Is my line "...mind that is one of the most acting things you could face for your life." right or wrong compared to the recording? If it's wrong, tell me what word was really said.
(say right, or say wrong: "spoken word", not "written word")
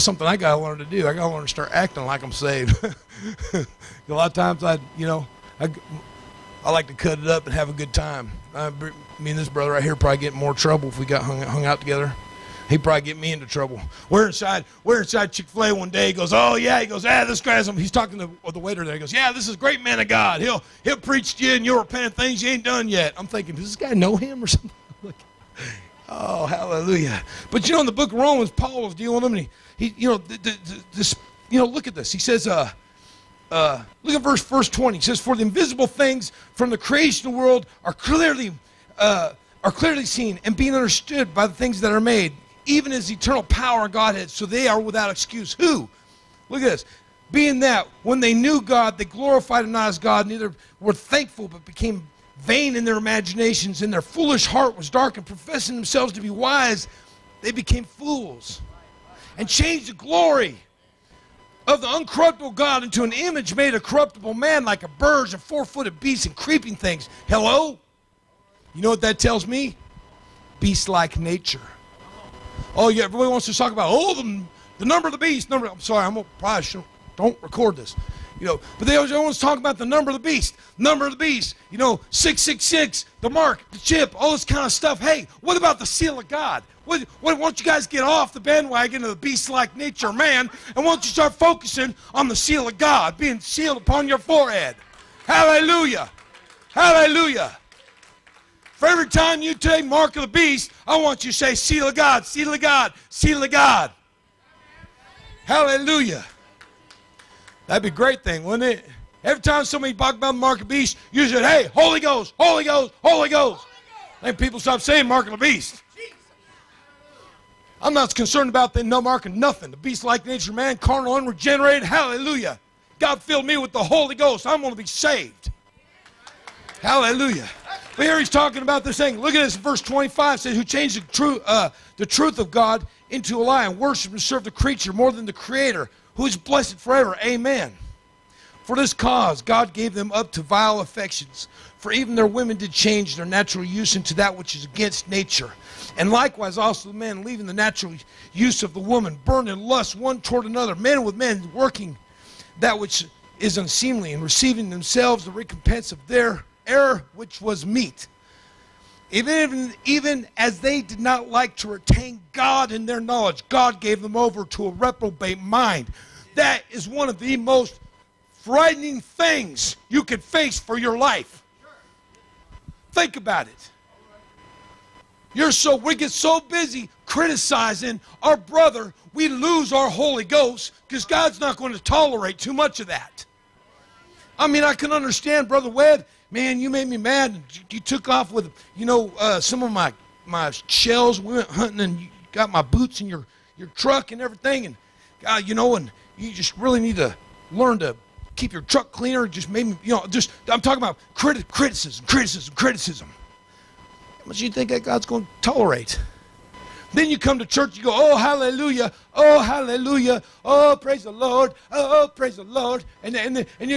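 wrong: "frightening", not "acting".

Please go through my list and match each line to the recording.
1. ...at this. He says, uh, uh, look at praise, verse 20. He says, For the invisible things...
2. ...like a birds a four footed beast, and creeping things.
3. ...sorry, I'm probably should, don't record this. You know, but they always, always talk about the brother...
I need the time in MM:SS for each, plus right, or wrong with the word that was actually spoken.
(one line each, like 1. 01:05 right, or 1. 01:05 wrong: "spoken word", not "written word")
1. 00:31 wrong: "verse", not "praise"
2. 01:04 right
3. 01:15 wrong: "number", not "brother".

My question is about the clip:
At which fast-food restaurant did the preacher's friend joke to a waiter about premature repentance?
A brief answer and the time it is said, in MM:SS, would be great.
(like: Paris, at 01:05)
Chick Fil A, at 00:15.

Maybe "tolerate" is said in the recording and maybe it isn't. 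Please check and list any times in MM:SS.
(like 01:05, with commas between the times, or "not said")
03:01, 03:25.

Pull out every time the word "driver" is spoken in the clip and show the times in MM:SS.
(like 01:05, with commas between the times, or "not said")
not said.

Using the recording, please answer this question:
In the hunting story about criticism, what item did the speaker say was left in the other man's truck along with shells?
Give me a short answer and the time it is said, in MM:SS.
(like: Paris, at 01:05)
boots, at 03:12.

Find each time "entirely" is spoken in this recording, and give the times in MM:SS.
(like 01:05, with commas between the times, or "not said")
not said.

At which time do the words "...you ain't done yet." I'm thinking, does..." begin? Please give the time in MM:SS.
00:22.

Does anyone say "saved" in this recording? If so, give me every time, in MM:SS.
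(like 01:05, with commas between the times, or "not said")
00:02, 02:04.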